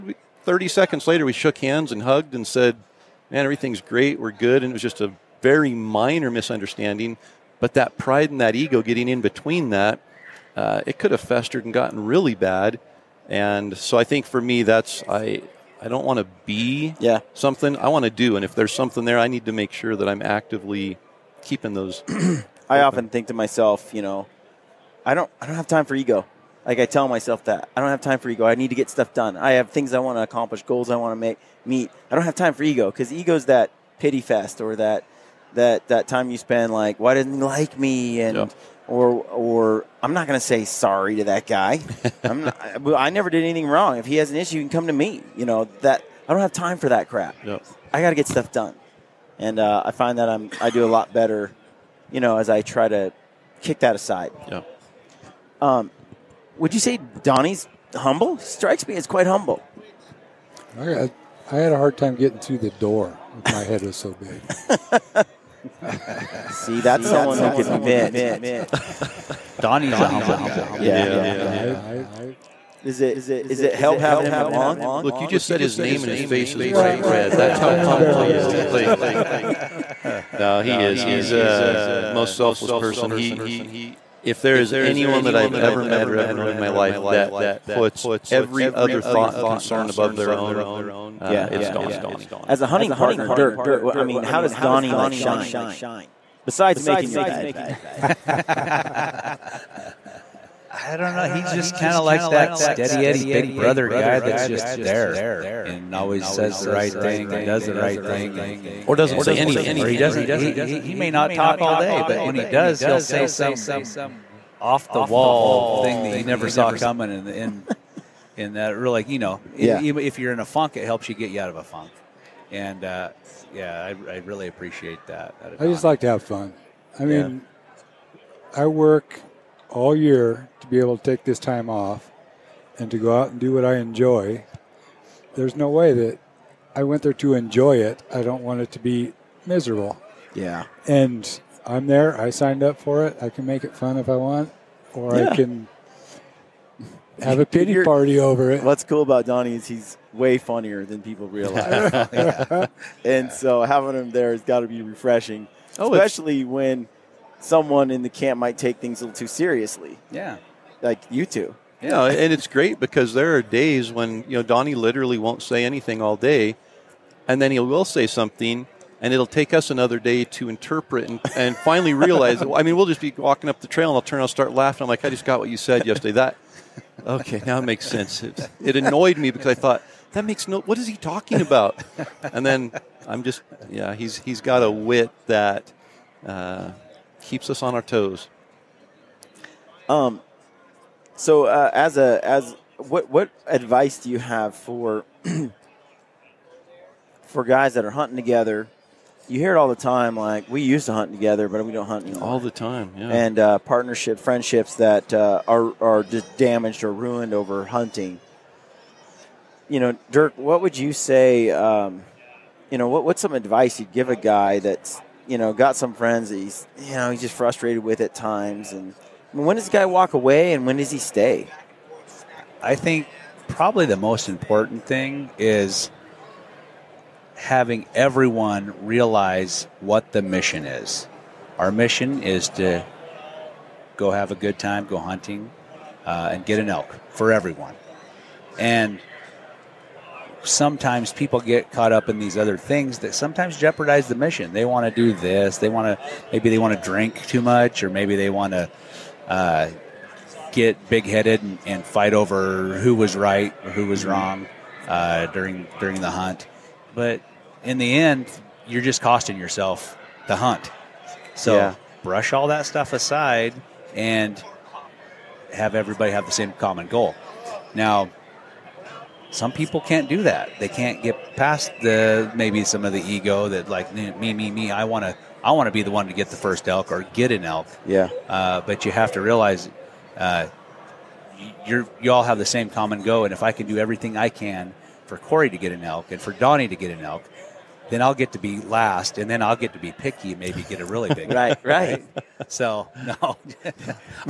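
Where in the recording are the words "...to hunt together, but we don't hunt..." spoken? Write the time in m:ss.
3:20.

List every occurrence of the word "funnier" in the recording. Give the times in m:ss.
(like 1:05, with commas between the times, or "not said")
2:30.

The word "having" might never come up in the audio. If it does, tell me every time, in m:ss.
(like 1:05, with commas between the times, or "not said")
1:13, 2:33, 3:47.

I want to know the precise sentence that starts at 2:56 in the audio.
That Okay, now it makes sense.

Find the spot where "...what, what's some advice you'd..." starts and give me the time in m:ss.
3:32.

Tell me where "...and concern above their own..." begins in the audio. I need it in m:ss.
1:29.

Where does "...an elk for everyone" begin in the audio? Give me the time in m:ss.
3:56.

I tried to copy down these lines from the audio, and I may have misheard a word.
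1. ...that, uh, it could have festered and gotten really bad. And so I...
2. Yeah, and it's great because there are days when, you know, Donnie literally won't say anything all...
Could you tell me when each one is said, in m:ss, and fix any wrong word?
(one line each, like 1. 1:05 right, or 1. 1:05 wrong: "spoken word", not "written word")
1. 0:09 right
2. 2:41 right.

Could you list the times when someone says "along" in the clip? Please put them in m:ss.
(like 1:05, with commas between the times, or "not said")
1:14.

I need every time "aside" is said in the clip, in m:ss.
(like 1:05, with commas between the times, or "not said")
0:53, 4:22.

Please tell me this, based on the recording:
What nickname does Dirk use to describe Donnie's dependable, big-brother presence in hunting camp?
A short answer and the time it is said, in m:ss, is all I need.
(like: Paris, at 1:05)
steady Eddie, at 1:42.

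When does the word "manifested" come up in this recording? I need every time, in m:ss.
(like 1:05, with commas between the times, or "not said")
not said.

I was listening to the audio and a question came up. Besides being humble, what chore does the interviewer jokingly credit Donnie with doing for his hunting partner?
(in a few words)
making your bed.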